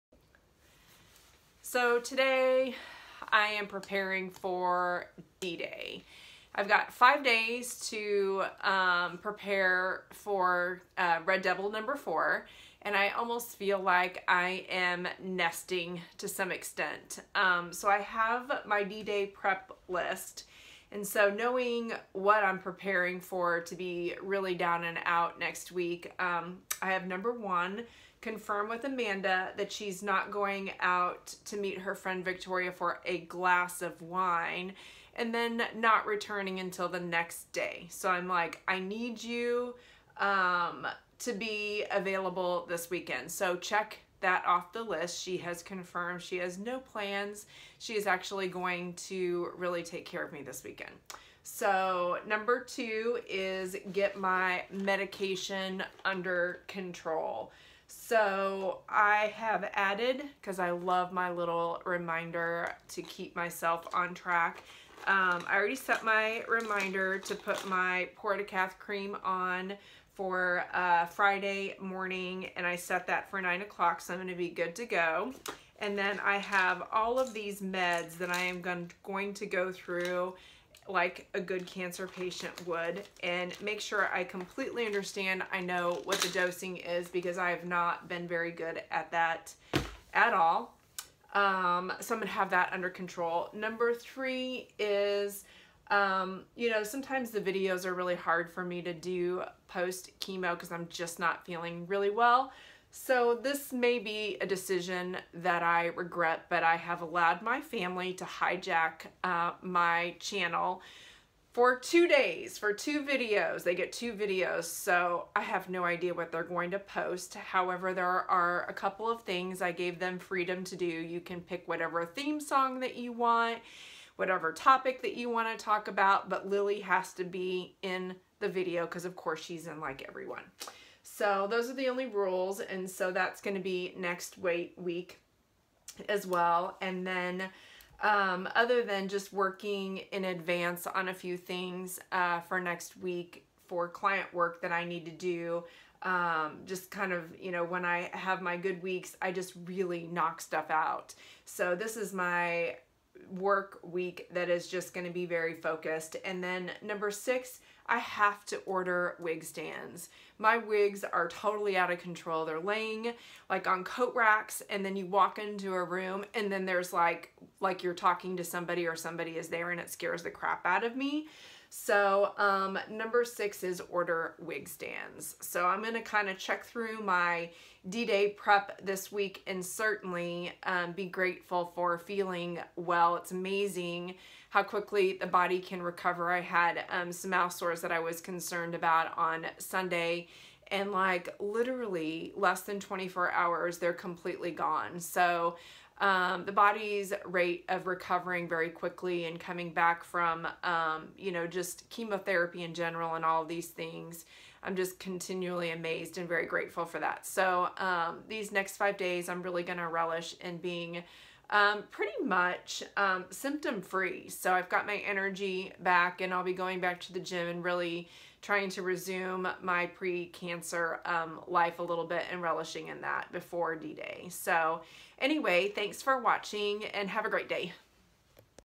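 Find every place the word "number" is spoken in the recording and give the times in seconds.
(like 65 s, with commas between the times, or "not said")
11 s, 27 s, 52 s, 93 s, 156 s, 172 s.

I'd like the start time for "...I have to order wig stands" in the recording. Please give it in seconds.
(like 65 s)
157 s.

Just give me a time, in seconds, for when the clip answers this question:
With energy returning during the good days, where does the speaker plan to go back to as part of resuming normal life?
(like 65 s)
217 s.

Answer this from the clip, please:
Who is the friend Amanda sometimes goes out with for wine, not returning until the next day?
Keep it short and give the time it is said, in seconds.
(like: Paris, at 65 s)
Victoria, at 32 s.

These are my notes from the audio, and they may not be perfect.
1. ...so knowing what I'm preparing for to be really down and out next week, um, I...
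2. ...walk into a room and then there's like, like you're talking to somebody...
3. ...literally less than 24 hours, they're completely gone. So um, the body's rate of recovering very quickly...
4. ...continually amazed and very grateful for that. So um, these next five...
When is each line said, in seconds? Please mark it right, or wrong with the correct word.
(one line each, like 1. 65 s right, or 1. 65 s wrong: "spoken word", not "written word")
1. 21 s right
2. 165 s right
3. 191 s right
4. 204 s right.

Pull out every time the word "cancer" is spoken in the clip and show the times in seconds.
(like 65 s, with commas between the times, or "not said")
81 s, 219 s.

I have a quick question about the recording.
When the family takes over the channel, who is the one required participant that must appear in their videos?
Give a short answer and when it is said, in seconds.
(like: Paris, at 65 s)
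Lily, at 126 s.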